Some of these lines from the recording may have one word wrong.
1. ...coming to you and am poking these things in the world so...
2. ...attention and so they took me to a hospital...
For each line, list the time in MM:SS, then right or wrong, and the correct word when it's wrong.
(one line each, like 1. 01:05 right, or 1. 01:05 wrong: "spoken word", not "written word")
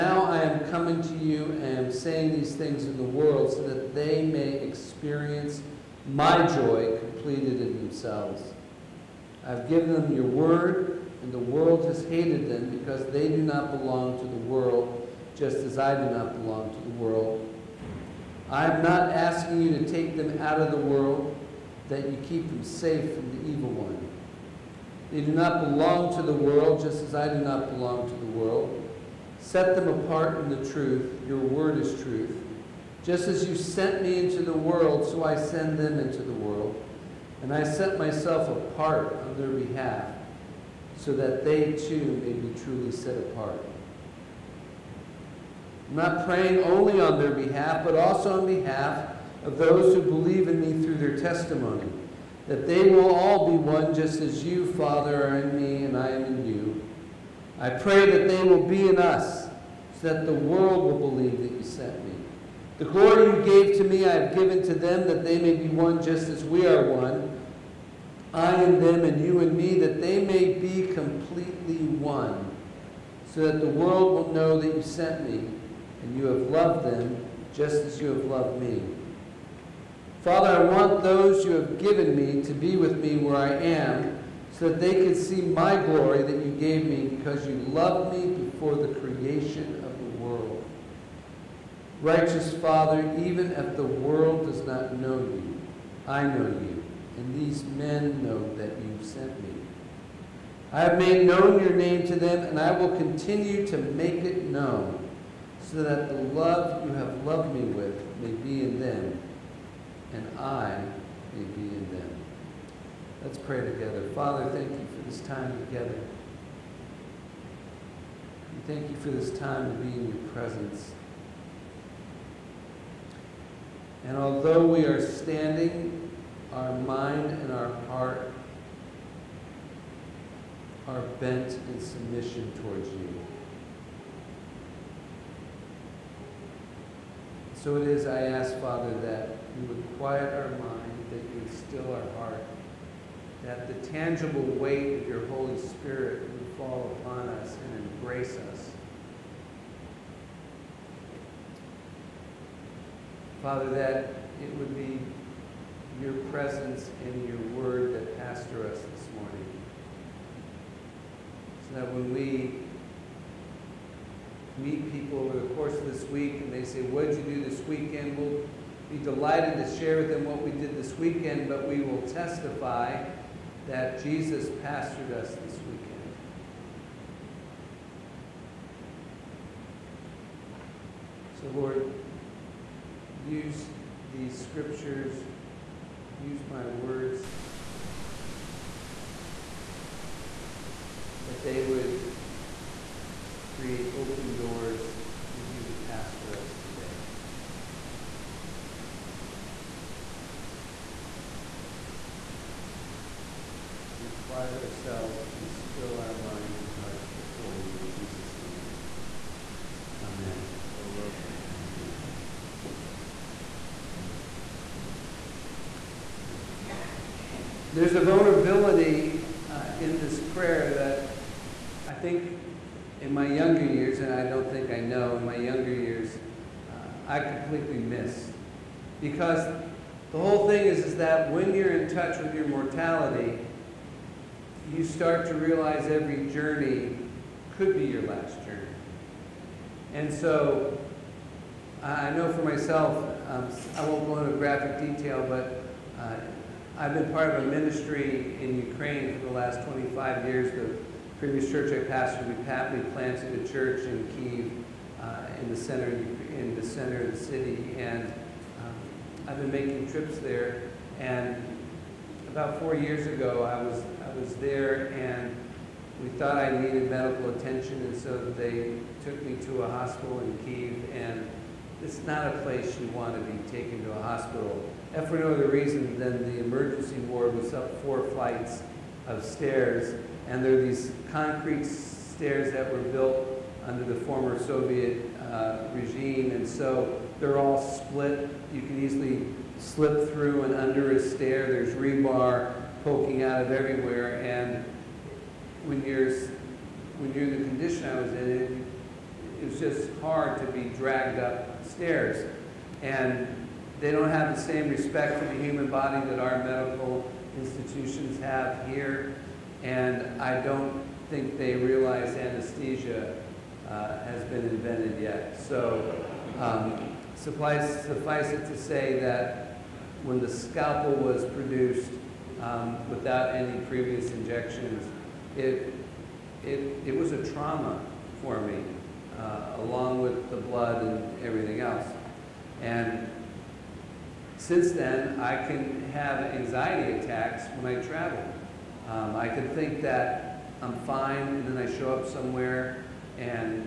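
1. 00:00 wrong: "saying", not "poking"
2. 04:27 right.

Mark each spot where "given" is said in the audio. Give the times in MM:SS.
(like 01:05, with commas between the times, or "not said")
00:09, 01:04, 01:21.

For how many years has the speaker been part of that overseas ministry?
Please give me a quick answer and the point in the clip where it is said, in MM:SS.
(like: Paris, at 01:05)
25 years, at 04:09.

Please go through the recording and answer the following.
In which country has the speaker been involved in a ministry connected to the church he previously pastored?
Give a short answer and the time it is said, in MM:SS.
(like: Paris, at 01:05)
Ukraine, at 04:08.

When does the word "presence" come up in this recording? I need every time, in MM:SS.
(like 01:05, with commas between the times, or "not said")
02:00, 02:36.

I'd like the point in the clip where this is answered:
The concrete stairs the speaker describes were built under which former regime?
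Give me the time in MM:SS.
04:44.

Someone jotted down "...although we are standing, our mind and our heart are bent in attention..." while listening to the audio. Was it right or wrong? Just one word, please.
wrong.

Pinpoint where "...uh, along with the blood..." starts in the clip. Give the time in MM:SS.
05:29.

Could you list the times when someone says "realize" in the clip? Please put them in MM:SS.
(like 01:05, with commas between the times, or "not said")
03:55, 05:11.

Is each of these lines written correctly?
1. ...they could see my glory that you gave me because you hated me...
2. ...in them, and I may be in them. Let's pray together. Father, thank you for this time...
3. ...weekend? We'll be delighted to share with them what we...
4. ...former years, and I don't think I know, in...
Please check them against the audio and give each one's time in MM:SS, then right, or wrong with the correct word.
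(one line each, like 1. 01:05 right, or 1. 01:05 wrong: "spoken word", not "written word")
1. 01:24 wrong: "loved", not "hated"
2. 01:48 right
3. 02:47 right
4. 03:43 wrong: "younger", not "former".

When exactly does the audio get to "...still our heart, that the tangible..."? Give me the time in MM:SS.
02:21.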